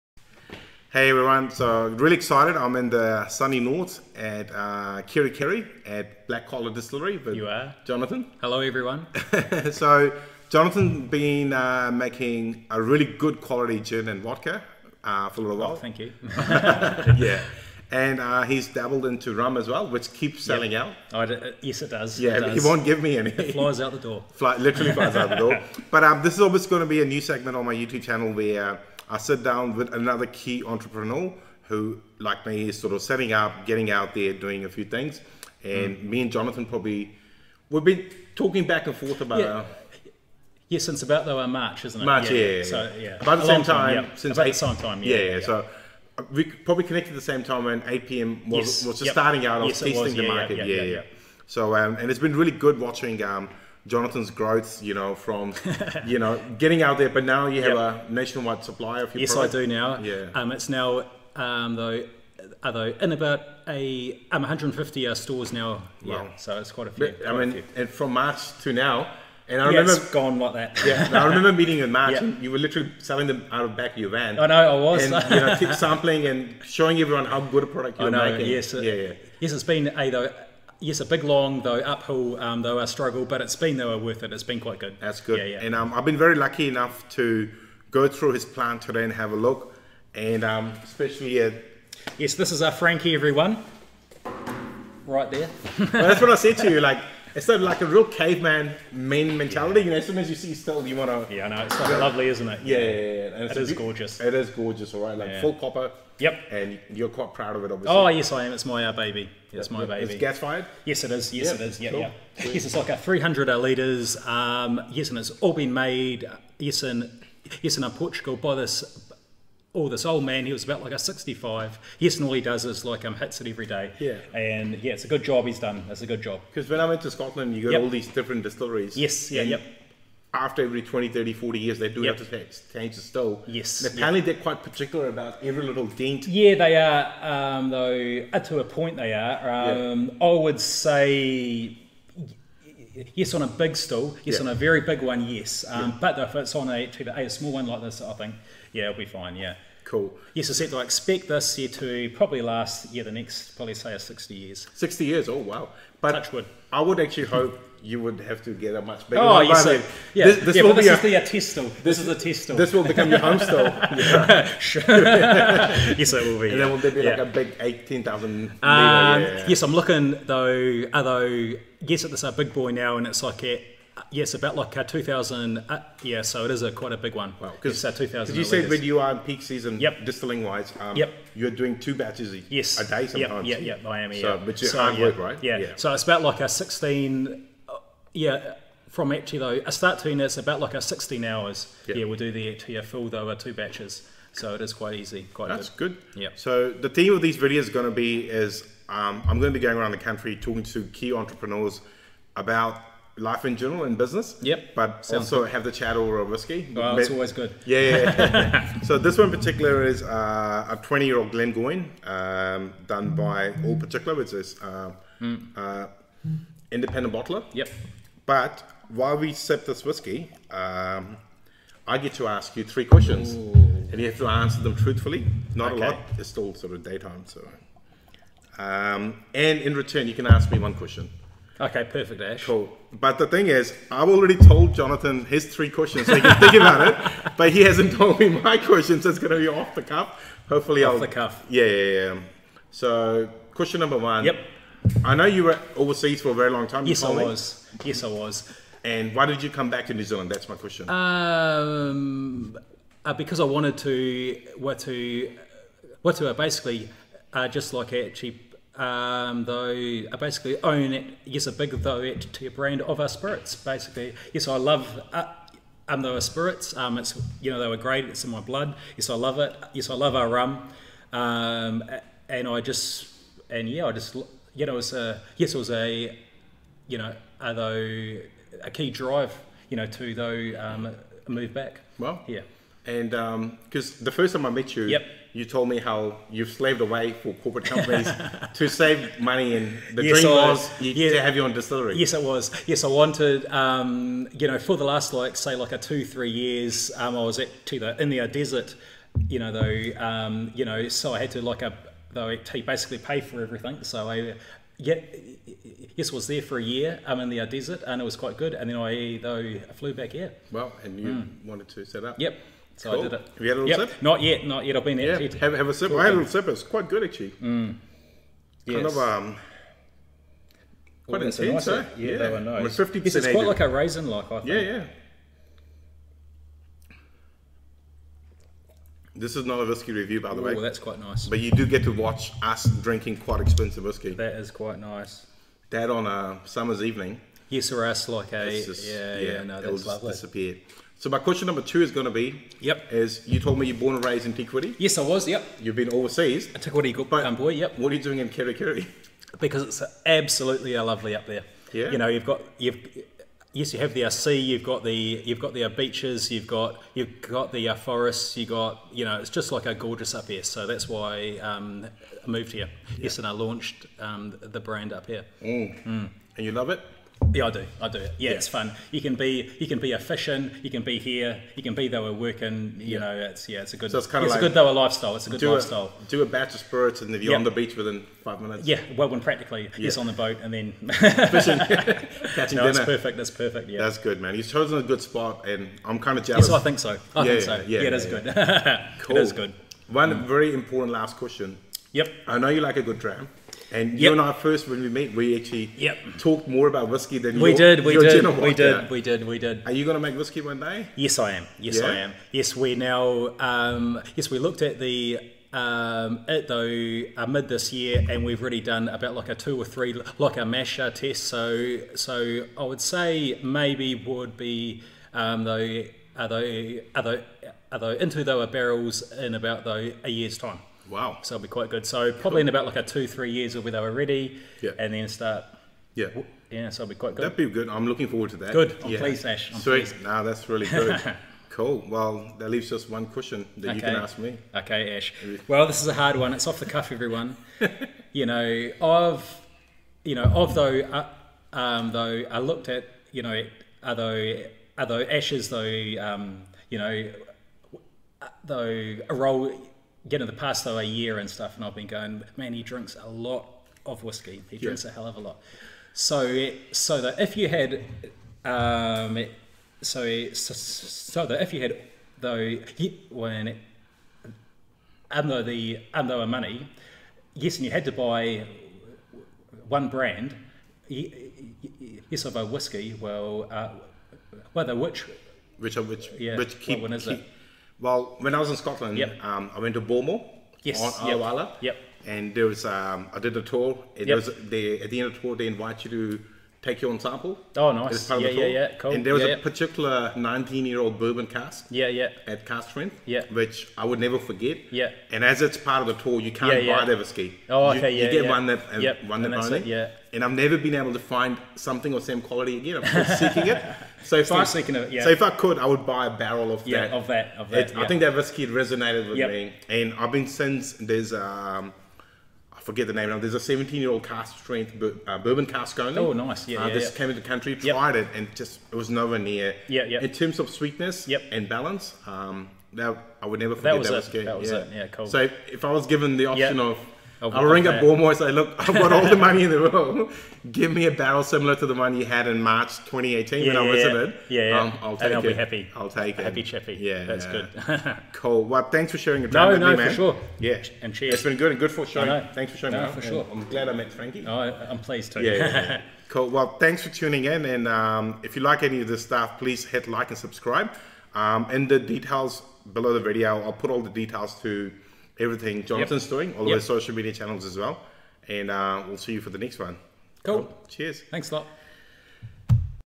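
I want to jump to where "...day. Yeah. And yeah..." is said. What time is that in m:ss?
2:03.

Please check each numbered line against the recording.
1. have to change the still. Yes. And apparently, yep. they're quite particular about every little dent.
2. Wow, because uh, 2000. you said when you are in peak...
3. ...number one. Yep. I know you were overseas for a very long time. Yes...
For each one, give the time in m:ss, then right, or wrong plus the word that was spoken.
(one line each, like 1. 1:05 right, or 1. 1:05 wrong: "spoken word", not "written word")
1. 2:12 right
2. 2:57 right
3. 4:03 right.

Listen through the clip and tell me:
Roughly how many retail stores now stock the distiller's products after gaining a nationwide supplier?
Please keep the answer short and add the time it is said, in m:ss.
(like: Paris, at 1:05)
150, at 1:04.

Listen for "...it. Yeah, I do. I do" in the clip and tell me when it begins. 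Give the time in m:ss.
6:06.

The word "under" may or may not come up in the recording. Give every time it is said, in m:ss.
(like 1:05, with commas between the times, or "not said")
7:45.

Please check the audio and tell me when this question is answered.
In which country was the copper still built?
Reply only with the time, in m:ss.
1:57.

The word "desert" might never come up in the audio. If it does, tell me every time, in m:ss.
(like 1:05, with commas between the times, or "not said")
4:58, 5:07.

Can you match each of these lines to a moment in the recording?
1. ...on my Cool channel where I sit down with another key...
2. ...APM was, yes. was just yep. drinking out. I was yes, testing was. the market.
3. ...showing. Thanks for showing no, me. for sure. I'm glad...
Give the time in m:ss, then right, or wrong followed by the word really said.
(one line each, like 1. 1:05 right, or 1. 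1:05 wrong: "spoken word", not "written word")
1. 0:27 wrong: "YouTube", not "Cool"
2. 0:47 wrong: "starting", not "drinking"
3. 9:01 right.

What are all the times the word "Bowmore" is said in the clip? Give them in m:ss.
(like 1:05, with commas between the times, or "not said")
7:59, 8:47.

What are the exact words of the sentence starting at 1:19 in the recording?
Yes, it's been a though yes, a big long though uphill um, though a struggle, but it's been though worth it.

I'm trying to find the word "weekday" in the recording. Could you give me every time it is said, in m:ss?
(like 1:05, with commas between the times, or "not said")
not said.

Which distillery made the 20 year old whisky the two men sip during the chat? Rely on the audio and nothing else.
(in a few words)
Glengoyne.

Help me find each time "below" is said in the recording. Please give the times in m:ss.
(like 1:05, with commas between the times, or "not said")
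9:12.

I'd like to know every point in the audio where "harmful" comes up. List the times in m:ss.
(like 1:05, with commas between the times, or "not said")
not said.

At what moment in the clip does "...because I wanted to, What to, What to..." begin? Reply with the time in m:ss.
4:13.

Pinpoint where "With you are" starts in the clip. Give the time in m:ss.
0:07.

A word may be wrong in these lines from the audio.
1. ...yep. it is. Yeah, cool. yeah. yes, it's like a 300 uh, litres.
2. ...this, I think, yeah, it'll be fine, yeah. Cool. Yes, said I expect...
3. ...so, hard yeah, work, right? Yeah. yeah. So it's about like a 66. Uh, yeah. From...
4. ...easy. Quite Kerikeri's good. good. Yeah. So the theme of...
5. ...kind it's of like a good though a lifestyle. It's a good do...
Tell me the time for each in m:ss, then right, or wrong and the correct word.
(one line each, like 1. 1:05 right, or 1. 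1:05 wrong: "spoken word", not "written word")
1. 1:51 right
2. 2:27 right
3. 3:04 wrong: "16", not "66"
4. 3:14 wrong: "That", not "Kerikeri"
5. 6:14 right.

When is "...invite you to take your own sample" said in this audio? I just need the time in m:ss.
8:05.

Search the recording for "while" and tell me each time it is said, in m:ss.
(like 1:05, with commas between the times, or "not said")
0:15, 3:38.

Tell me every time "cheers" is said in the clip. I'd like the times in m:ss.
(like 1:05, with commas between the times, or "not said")
9:00, 9:20.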